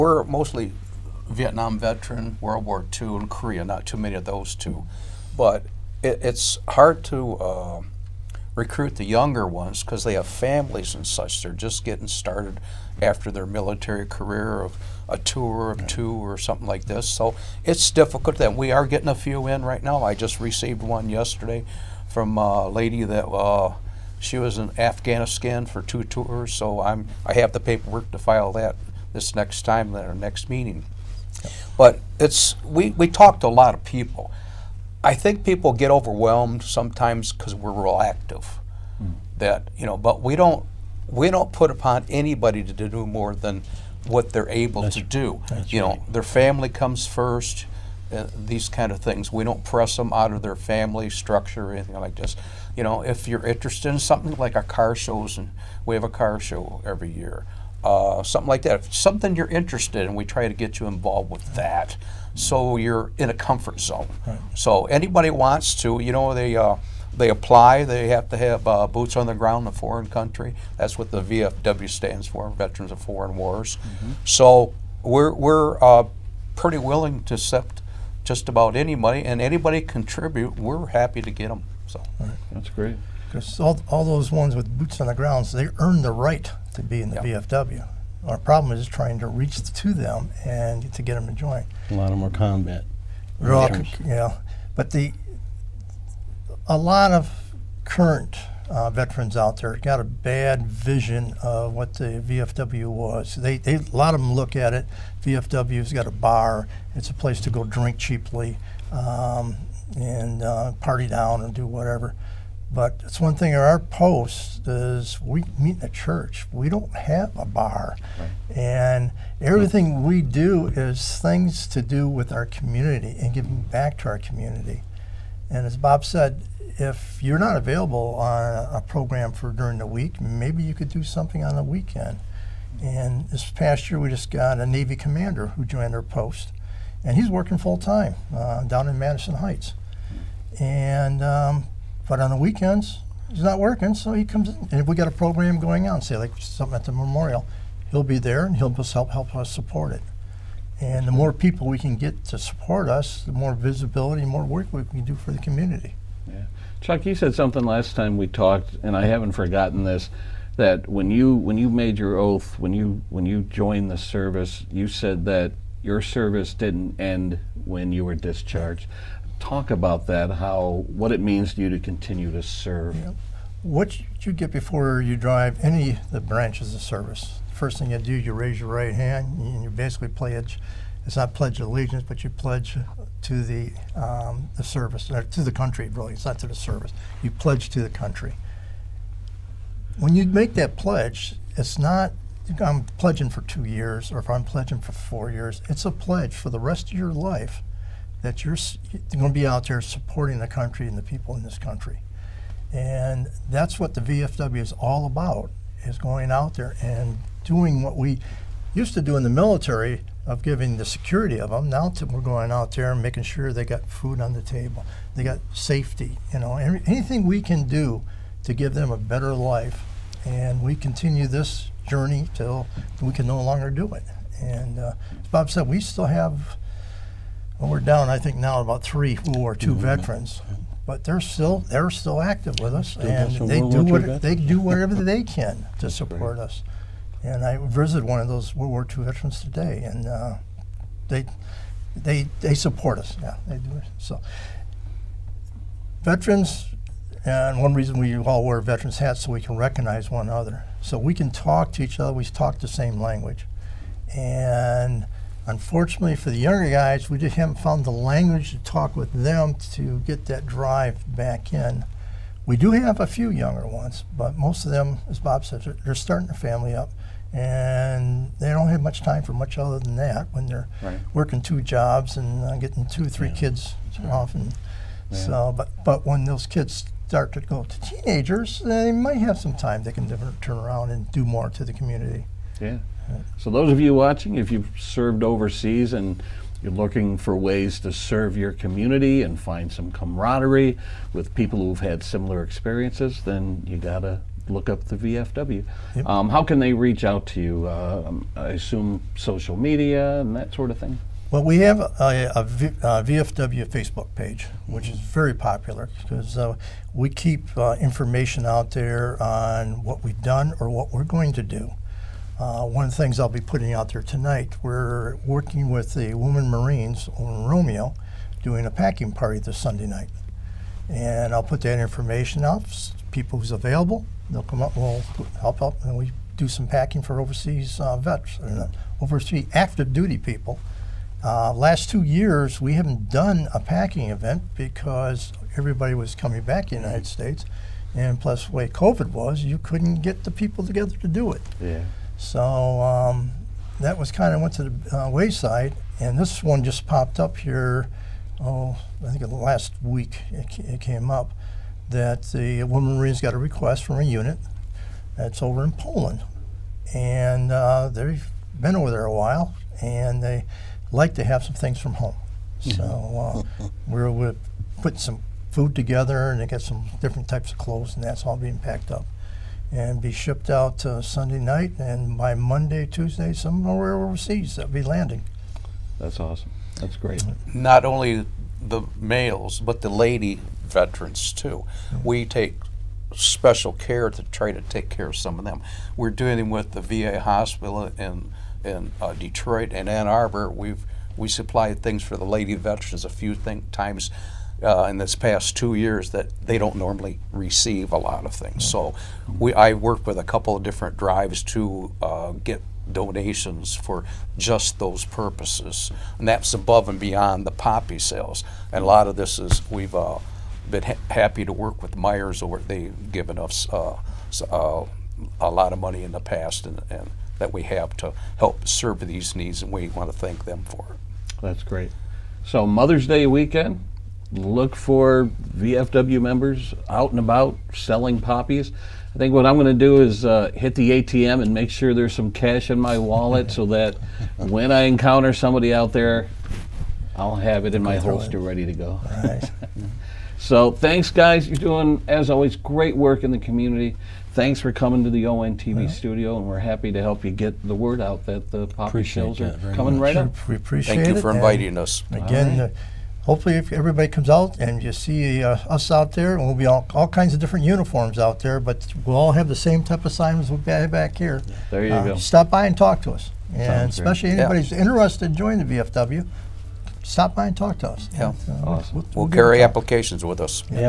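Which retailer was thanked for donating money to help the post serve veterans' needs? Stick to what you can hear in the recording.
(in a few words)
Meijer's.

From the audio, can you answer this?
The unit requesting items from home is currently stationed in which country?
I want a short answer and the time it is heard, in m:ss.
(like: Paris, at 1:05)
Poland, at 5:55.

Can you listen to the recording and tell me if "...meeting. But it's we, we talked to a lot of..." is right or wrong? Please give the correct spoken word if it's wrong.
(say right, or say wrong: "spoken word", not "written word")
right.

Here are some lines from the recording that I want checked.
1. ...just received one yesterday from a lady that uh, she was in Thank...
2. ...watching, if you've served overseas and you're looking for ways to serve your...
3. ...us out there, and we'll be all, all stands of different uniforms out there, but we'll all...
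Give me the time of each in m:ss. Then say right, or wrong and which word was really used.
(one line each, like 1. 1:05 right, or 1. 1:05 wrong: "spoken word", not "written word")
1. 0:20 wrong: "Afghanistan", not "Thank"
2. 4:43 right
3. 7:35 wrong: "kinds", not "stands".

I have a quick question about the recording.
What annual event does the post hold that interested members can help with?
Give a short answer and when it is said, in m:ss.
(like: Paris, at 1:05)
car show, at 0:56.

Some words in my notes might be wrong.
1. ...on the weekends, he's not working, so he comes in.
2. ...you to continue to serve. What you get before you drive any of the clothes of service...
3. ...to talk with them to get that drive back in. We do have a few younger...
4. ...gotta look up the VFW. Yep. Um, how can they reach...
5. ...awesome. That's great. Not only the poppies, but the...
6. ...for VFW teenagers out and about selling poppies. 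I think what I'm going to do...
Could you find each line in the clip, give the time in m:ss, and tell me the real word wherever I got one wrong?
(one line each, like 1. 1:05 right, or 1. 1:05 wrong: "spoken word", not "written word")
1. 2:22 right
2. 2:51 wrong: "branches", not "clothes"
3. 4:18 right
4. 4:53 right
5. 6:16 wrong: "males", not "poppies"
6. 7:04 wrong: "members", not "teenagers".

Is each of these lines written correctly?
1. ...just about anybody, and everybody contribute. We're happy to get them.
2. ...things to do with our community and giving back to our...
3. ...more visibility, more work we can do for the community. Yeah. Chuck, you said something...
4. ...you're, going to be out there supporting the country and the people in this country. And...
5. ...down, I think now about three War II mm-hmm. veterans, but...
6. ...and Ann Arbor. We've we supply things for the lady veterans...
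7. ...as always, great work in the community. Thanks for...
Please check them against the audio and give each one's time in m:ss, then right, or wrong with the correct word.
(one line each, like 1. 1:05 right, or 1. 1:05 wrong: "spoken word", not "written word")
1. 1:18 wrong: "anybody", not "everybody"
2. 2:01 right
3. 2:33 right
4. 3:18 right
5. 3:47 right
6. 6:29 right
7. 7:22 right.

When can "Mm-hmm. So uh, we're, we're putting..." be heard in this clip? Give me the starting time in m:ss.
6:02.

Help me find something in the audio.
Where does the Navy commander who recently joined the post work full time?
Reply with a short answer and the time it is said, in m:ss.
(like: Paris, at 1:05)
Madison Heights, at 2:18.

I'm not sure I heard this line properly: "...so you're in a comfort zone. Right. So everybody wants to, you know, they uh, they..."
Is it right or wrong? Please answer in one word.
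wrong.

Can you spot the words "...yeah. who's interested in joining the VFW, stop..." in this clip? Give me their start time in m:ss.
7:44.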